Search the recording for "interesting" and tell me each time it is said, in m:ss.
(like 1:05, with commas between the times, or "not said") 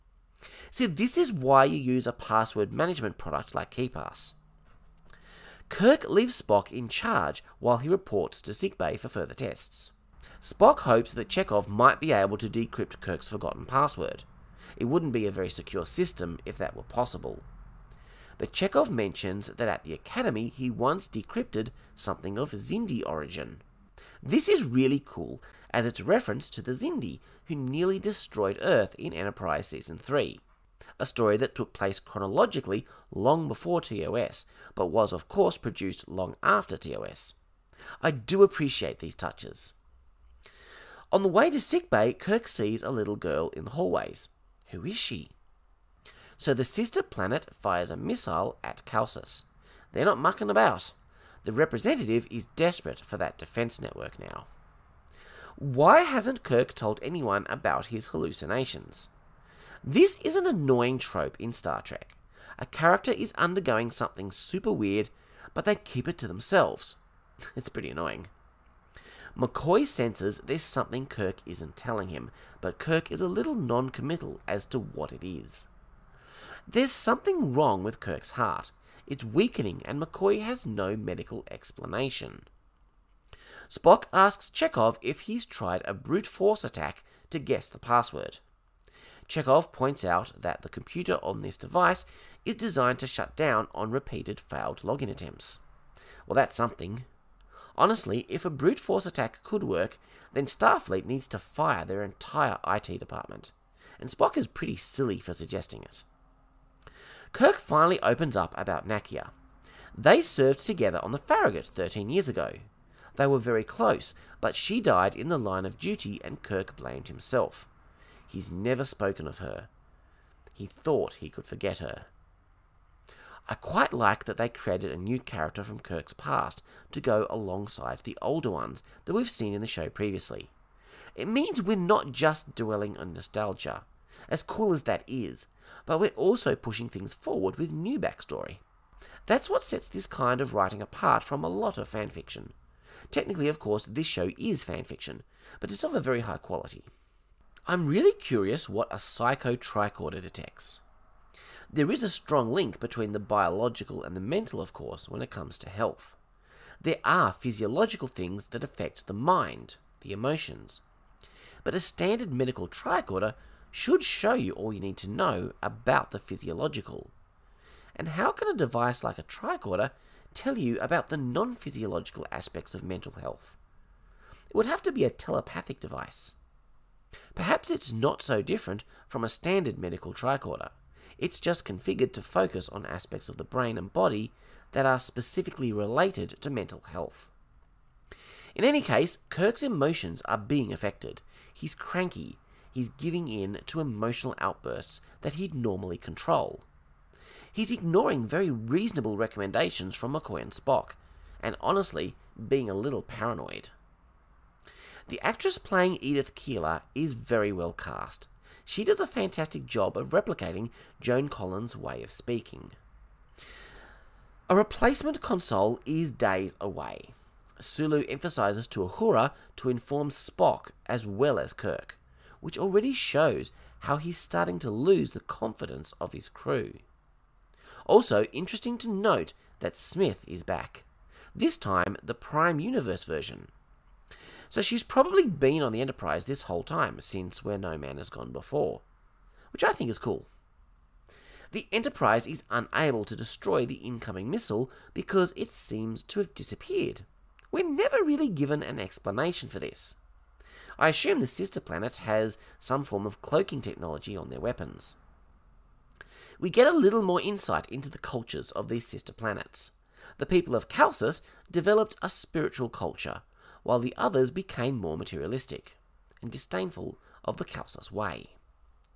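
3:48.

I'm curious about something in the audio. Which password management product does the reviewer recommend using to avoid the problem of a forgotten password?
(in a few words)
KeePass.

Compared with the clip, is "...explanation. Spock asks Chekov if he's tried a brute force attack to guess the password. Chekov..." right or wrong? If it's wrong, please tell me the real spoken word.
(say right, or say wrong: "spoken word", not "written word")
right.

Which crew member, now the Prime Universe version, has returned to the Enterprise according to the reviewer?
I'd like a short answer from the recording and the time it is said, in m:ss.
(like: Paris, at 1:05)
Smith, at 3:49.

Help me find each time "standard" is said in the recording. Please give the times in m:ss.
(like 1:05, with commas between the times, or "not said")
2:41, 2:59.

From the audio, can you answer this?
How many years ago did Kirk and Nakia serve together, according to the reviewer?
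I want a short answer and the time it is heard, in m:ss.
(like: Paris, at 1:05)
13, at 1:51.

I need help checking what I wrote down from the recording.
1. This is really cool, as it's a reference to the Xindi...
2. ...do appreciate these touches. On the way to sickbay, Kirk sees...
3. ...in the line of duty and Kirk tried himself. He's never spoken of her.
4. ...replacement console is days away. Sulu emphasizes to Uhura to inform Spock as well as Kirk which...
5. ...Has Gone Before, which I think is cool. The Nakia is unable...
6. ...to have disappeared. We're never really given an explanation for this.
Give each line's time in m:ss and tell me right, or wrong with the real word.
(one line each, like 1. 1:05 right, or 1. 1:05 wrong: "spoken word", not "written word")
1. 0:24 right
2. 0:38 right
3. 1:55 wrong: "blamed", not "tried"
4. 3:34 right
5. 3:57 wrong: "Enterprise", not "Nakia"
6. 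4:06 right.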